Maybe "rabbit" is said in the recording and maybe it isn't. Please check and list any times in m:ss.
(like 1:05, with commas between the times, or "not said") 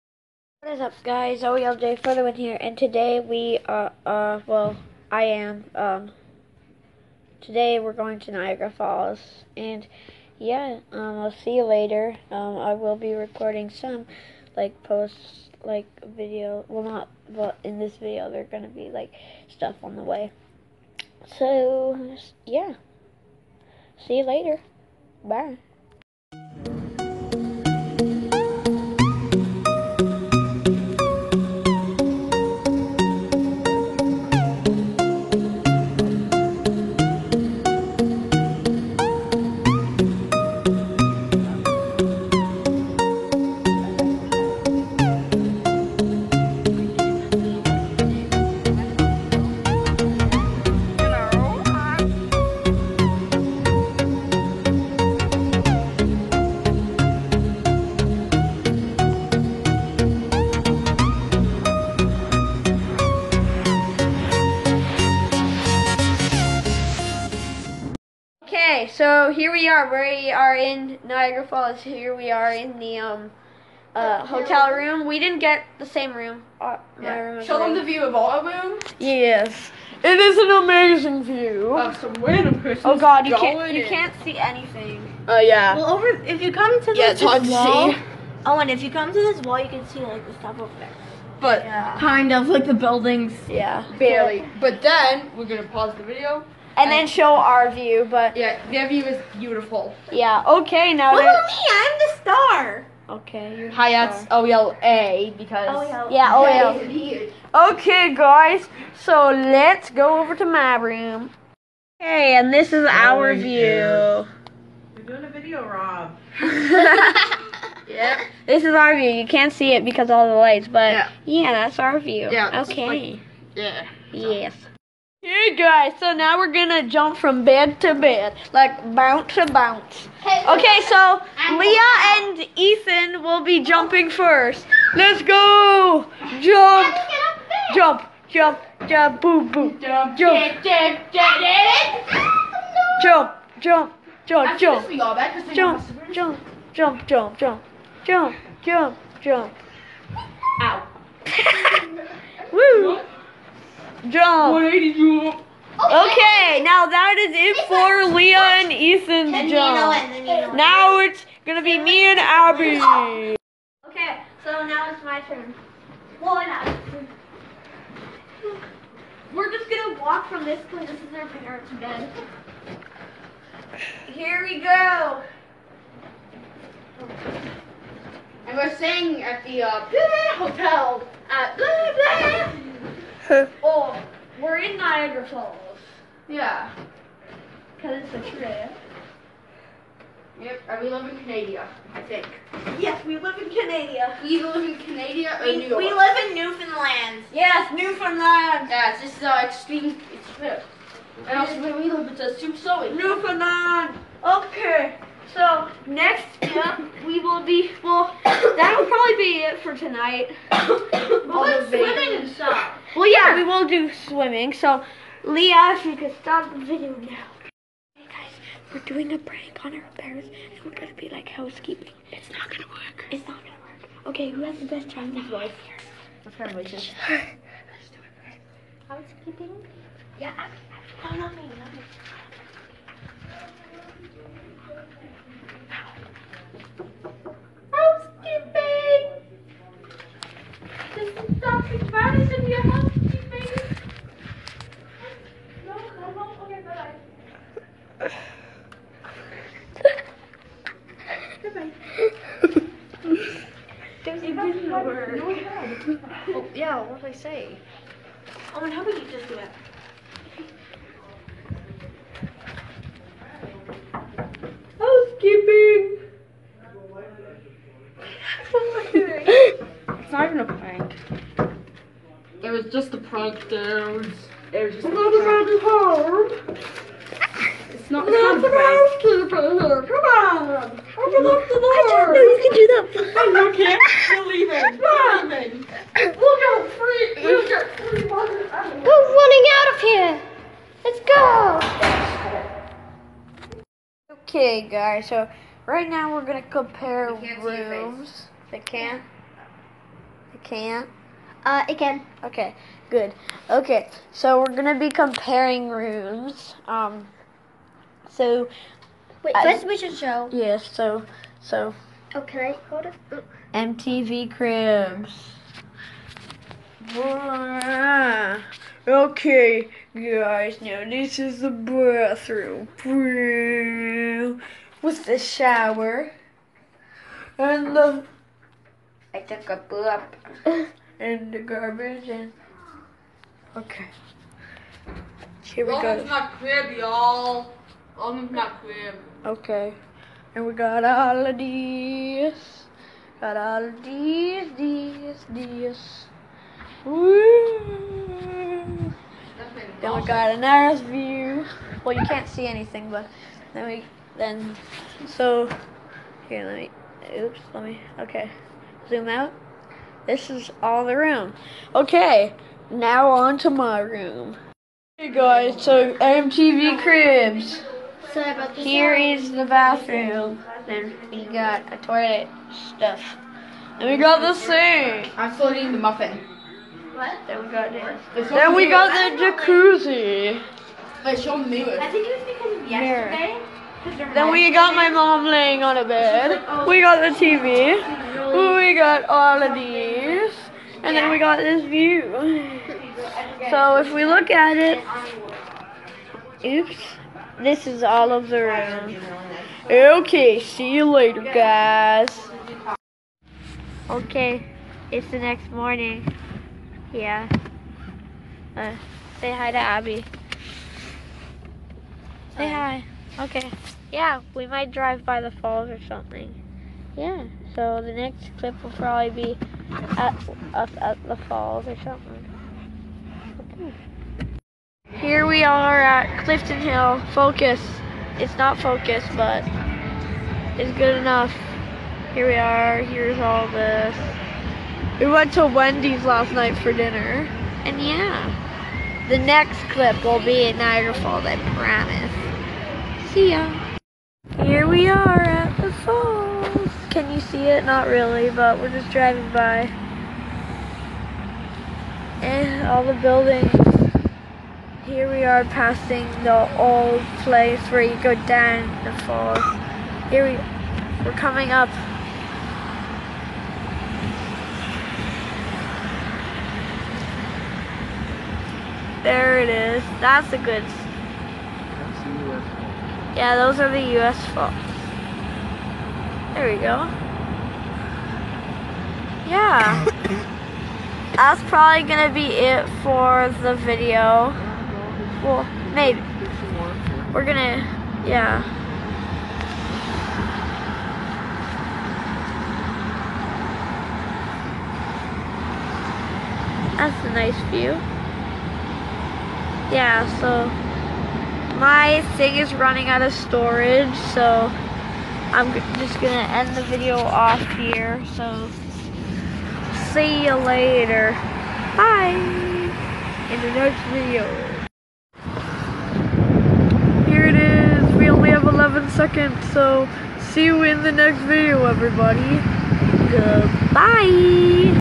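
not said.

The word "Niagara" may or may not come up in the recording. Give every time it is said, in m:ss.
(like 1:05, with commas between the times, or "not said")
0:08, 1:11, 7:20.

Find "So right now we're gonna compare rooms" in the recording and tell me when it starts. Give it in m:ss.
4:55.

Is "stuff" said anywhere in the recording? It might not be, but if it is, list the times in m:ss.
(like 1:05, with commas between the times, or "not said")
0:19, 1:30, 3:32, 6:12.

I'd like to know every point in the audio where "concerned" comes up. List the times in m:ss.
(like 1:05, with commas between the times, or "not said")
not said.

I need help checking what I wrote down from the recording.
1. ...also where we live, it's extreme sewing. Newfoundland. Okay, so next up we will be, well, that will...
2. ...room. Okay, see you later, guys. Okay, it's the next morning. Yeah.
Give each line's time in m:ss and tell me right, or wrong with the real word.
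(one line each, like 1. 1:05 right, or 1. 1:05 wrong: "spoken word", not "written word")
1. 3:21 right
2. 6:38 right.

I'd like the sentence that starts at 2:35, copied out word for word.
Okay, now that is it for Leah and Ethan's jump.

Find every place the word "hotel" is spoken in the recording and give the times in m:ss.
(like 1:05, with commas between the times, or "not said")
1:14, 3:00.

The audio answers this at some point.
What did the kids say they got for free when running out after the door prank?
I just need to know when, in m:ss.
4:47.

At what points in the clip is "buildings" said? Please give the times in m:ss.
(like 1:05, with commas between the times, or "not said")
1:32, 7:32.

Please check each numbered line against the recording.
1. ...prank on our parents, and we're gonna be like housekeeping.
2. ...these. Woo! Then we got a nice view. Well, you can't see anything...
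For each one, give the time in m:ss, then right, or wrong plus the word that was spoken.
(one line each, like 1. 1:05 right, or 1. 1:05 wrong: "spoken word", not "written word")
1. 3:39 right
2. 5:45 right.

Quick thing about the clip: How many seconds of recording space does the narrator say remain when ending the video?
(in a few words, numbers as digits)
11.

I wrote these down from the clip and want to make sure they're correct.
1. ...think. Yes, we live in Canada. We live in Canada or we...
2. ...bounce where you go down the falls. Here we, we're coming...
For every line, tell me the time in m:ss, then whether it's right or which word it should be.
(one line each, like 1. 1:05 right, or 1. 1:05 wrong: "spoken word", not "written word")
1. 3:12 right
2. 7:37 wrong: "place", not "bounce".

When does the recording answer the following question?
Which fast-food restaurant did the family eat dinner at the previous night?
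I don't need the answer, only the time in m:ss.
7:14.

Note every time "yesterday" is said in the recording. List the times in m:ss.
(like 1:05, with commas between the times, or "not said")
6:22.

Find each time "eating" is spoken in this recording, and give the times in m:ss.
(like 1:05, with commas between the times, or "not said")
6:15.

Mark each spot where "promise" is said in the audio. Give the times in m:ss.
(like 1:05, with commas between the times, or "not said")
7:21.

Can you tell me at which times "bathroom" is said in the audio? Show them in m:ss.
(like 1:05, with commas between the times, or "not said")
5:21, 6:09.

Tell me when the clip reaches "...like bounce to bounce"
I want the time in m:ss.
2:08.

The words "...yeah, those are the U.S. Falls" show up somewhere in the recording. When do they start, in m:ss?
7:53.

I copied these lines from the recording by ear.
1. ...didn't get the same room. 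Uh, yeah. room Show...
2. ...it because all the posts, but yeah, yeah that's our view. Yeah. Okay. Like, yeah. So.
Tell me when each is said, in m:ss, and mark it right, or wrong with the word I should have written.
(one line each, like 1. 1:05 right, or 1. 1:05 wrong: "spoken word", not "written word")
1. 1:15 right
2. 1:59 wrong: "lights", not "posts".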